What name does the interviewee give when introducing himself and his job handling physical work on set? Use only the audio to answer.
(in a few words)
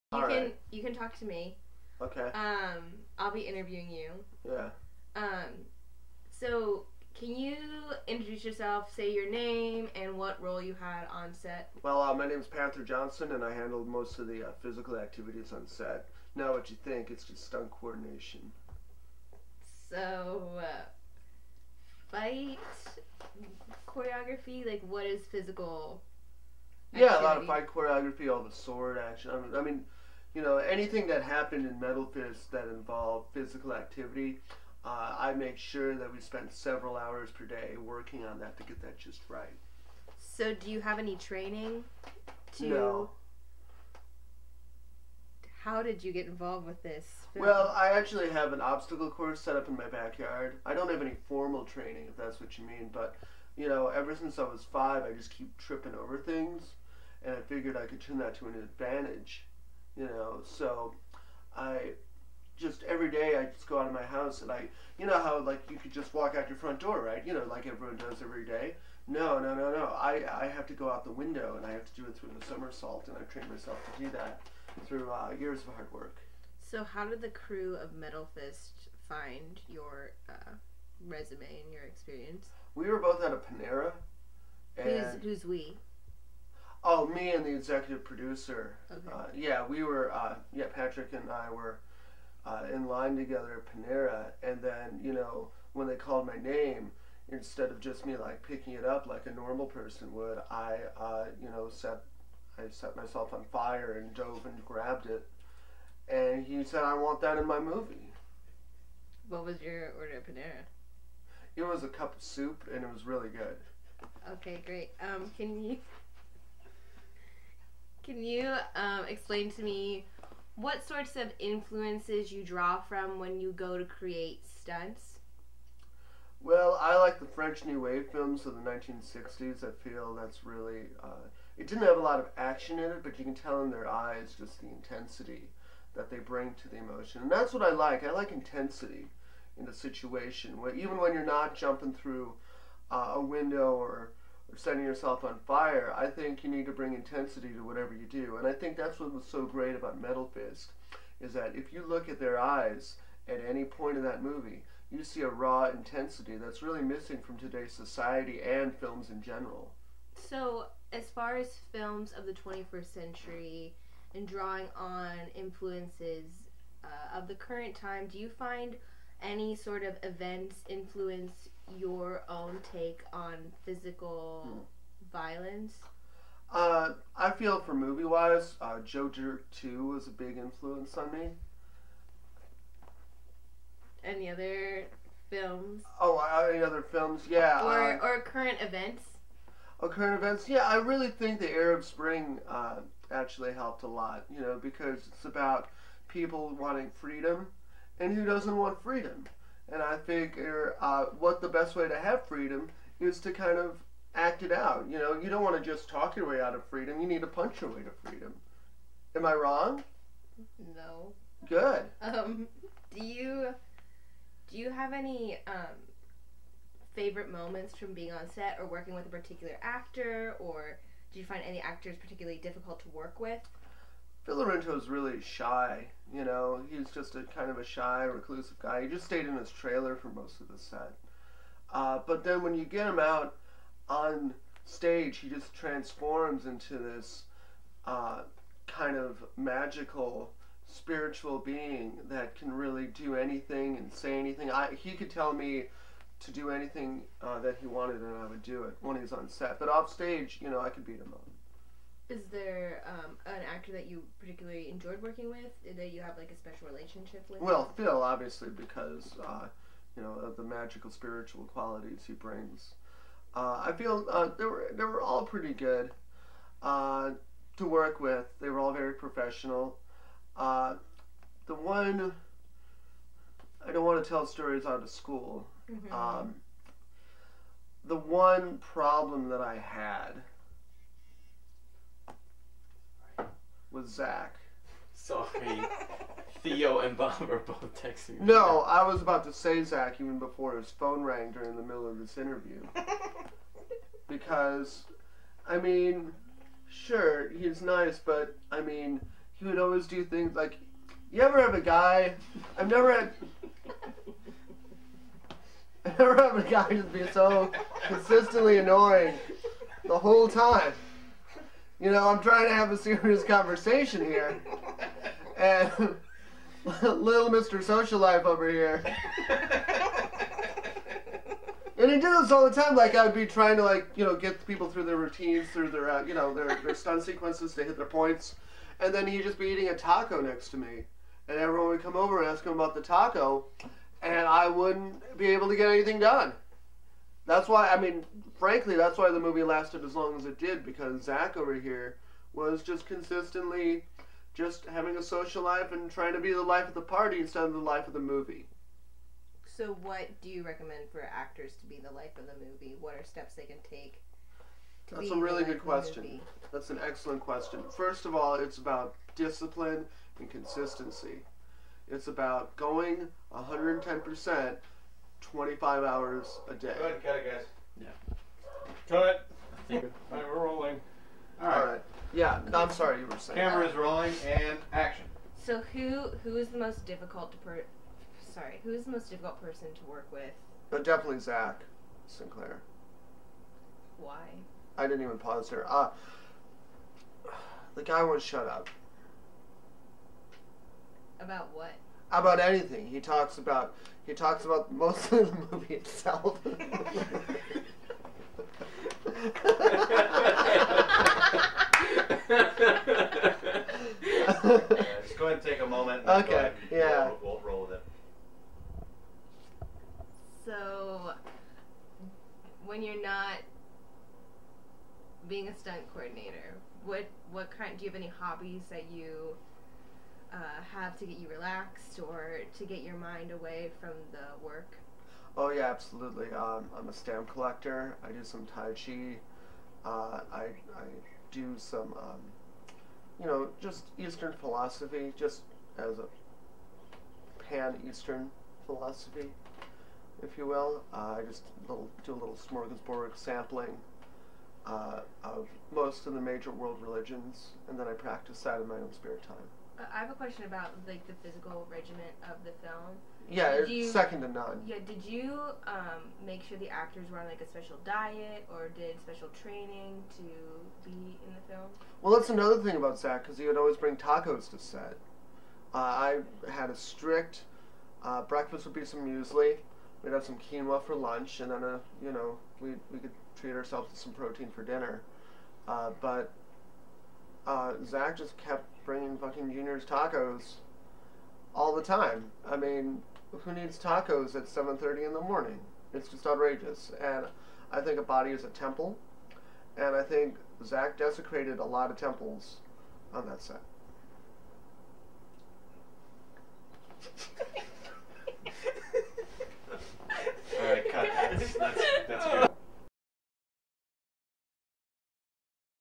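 Panther Johnson.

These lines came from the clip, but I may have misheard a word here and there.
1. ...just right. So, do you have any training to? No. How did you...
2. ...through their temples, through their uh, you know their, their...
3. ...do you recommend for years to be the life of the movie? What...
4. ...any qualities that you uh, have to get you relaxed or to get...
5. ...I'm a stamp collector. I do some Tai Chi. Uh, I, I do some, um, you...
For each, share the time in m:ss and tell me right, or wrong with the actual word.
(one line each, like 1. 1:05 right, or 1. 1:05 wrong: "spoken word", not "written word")
1. 0:38 right
2. 5:24 wrong: "routines", not "temples"
3. 5:50 wrong: "actors", not "years"
4. 6:57 wrong: "hobbies", not "qualities"
5. 7:06 right.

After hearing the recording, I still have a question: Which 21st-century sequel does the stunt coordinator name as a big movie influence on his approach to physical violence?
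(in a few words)
Joe Dirt 2.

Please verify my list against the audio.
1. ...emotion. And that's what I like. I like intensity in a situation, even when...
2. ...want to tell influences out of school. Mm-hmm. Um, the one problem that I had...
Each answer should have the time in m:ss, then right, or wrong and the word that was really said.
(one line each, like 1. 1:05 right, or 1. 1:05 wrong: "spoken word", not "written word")
1. 2:16 right
2. 4:33 wrong: "stories", not "influences".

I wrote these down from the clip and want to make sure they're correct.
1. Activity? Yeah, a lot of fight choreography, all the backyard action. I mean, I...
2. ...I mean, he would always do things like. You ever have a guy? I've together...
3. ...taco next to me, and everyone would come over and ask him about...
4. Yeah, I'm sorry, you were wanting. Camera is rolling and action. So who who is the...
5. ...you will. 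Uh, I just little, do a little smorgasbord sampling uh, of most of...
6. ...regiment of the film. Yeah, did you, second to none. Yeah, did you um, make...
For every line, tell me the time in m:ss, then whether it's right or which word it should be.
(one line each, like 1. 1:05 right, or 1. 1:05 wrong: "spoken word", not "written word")
1. 0:26 wrong: "sword", not "backyard"
2. 4:58 wrong: "never", not "together"
3. 5:29 right
4. 6:12 wrong: "saying", not "wanting"
5. 7:20 right
6. 7:31 right.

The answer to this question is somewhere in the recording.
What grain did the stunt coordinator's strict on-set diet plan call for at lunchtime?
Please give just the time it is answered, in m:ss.
7:50.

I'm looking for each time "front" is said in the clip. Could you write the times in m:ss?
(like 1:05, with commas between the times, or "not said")
1:06.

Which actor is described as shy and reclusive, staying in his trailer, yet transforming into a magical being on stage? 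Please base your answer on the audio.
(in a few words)
Phil Laurento.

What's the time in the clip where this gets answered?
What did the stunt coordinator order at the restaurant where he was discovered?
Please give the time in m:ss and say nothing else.
1:51.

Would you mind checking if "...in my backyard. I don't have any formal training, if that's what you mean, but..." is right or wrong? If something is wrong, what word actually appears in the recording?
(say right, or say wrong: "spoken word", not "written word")
right.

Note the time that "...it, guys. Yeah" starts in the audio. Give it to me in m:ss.
6:07.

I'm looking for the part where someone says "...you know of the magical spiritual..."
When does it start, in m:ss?
4:19.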